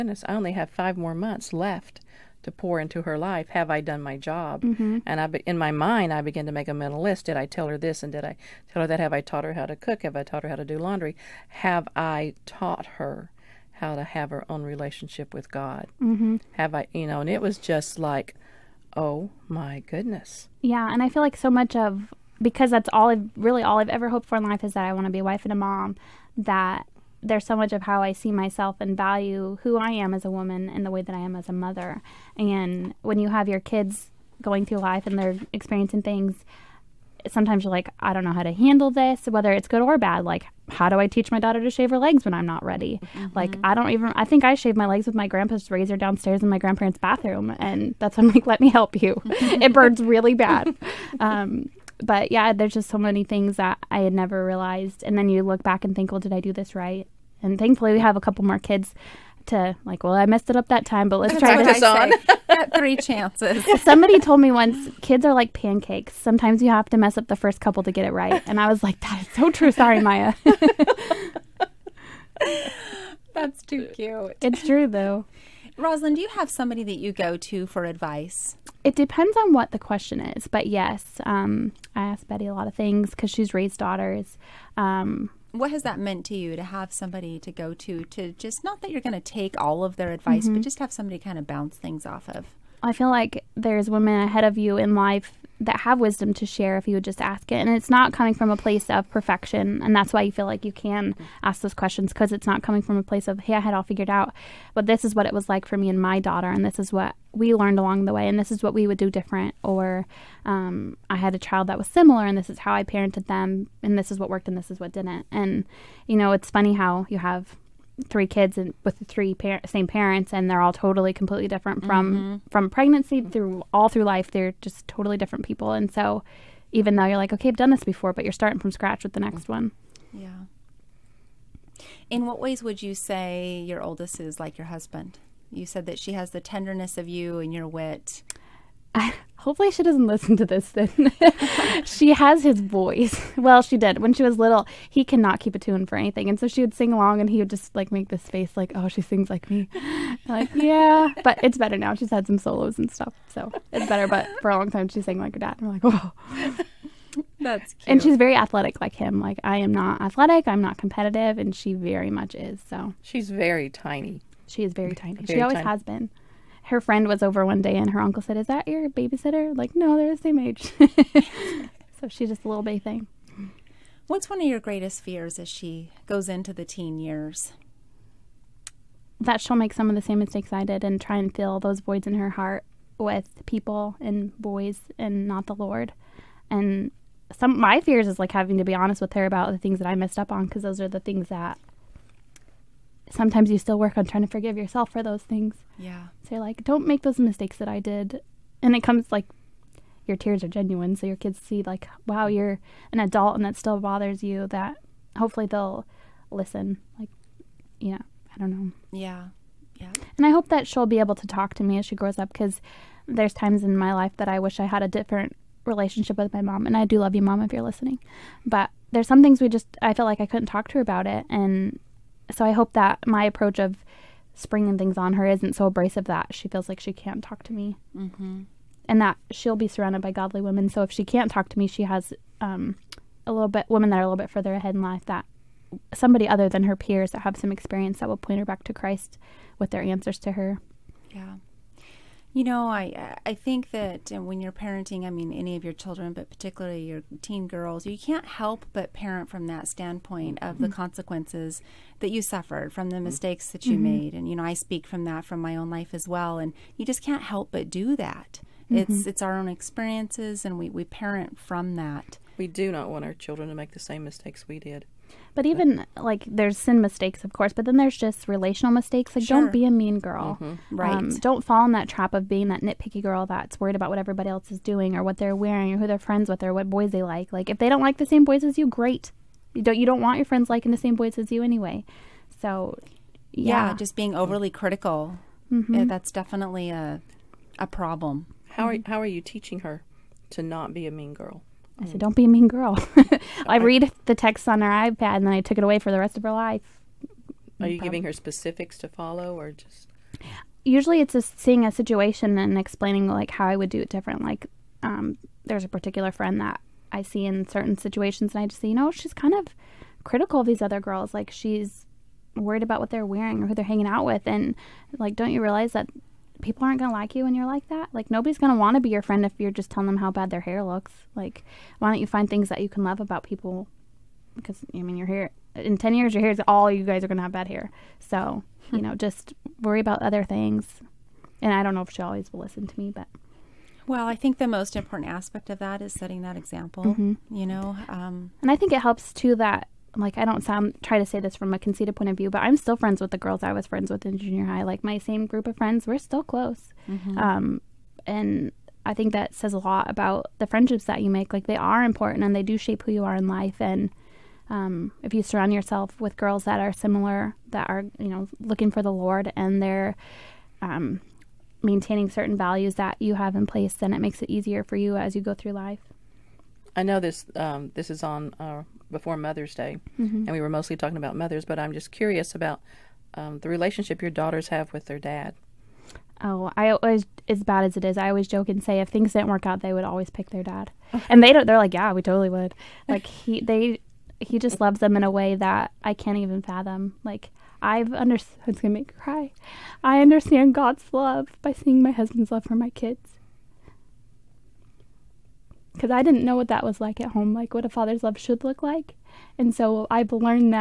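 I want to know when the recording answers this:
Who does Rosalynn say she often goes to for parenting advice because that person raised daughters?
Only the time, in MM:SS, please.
01:22.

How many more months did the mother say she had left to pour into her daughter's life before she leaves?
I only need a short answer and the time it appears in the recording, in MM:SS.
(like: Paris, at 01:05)
5, at 00:00.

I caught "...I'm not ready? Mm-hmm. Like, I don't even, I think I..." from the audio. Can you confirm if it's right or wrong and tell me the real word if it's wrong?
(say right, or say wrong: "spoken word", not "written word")
right.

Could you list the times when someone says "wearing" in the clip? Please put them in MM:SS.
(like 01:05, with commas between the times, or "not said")
04:35, 05:13.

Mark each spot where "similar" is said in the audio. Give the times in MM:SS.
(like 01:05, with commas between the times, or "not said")
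01:51, 05:56.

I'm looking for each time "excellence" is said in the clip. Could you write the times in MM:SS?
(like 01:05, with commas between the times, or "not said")
not said.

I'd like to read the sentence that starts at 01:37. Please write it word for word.
And it's not coming from a place of perfection.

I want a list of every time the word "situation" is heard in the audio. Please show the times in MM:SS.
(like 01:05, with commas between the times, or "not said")
05:01, 05:07.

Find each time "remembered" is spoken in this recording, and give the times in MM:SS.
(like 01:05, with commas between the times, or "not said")
not said.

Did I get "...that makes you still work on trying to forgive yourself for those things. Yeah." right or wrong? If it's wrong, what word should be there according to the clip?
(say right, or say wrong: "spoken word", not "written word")
wrong: "sometimes", not "makes".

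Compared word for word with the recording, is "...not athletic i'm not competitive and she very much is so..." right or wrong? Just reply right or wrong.
right.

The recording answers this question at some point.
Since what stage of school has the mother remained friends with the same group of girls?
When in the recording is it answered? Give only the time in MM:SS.
05:44.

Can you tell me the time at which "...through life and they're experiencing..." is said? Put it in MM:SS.
00:34.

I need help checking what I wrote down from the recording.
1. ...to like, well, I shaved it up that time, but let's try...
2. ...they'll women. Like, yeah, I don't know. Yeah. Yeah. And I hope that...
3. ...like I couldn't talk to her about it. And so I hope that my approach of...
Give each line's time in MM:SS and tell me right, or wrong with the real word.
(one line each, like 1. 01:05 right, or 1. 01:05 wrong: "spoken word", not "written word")
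1. 00:59 wrong: "messed", not "shaved"
2. 03:25 wrong: "listen", not "women"
3. 03:40 right.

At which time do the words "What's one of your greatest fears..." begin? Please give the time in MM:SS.
02:54.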